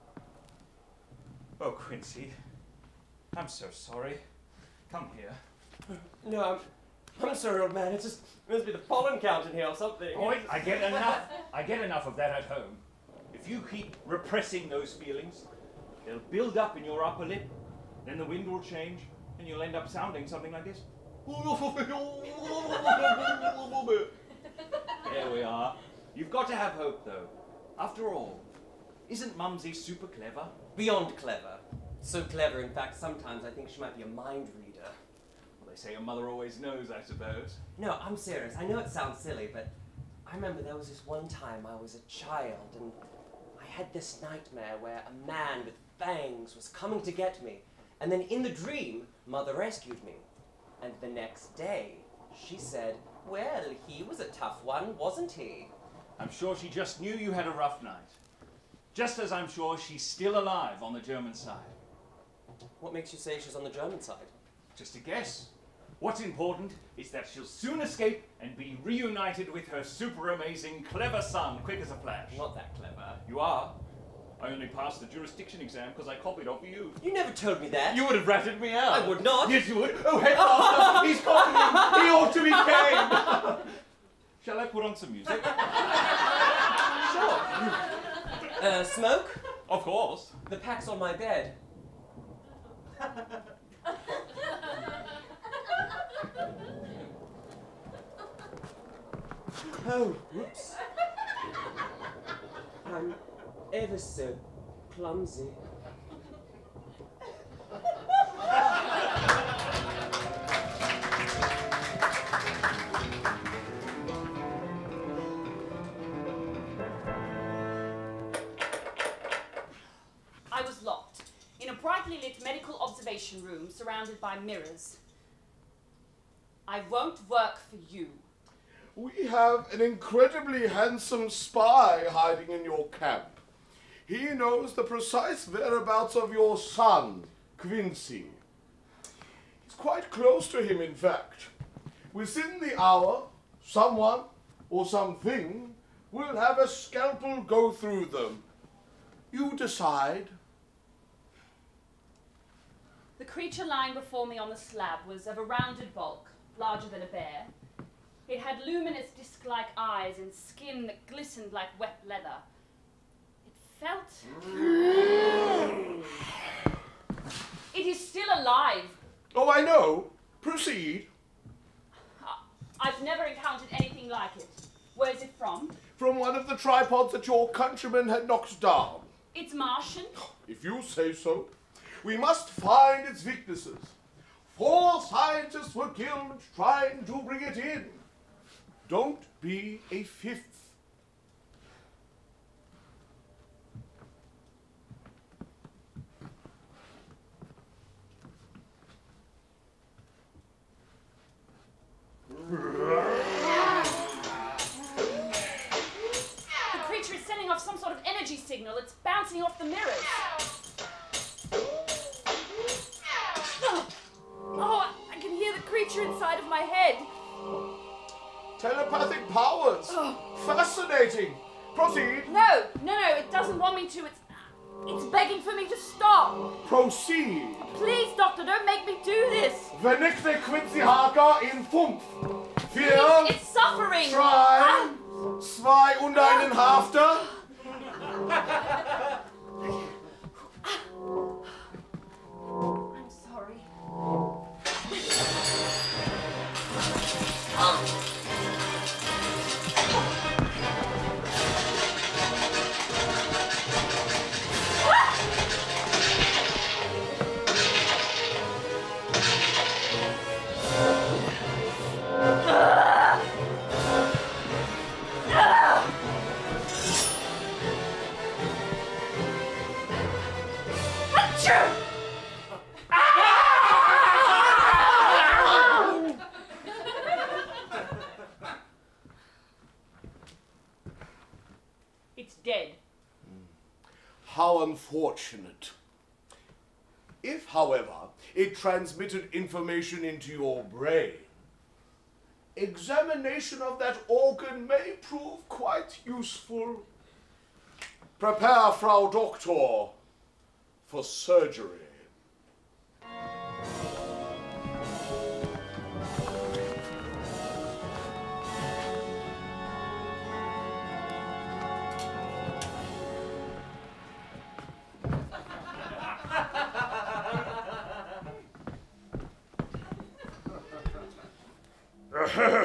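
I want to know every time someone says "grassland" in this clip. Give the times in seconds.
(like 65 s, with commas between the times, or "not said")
not said.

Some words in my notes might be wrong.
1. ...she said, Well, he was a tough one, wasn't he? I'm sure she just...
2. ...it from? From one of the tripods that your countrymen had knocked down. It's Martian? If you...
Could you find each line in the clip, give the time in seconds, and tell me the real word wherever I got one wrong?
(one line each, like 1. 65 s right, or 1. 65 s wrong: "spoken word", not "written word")
1. 52 s right
2. 175 s right.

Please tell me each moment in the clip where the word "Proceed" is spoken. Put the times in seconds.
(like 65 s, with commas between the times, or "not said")
170 s, 221 s, 226 s.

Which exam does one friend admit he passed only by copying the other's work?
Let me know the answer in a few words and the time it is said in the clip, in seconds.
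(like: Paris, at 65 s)
The jurisdiction exam, at 75 s.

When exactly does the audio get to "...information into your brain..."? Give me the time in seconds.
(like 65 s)
289 s.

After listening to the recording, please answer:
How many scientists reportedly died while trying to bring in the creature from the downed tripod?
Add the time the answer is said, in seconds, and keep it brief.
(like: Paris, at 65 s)
4, at 184 s.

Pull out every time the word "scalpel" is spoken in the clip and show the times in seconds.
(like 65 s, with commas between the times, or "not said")
146 s.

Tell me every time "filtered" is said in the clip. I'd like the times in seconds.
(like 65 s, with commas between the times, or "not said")
not said.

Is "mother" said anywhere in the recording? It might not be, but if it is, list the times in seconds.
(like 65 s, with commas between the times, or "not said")
36 s, 49 s.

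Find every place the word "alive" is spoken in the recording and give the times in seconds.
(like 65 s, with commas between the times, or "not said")
60 s, 168 s.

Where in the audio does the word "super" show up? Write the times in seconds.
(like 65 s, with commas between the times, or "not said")
29 s, 69 s.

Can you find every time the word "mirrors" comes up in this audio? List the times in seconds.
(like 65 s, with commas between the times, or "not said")
124 s, 209 s.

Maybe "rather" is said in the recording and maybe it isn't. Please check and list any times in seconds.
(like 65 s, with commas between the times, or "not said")
not said.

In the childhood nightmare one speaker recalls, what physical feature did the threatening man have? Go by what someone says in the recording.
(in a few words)
Fangs.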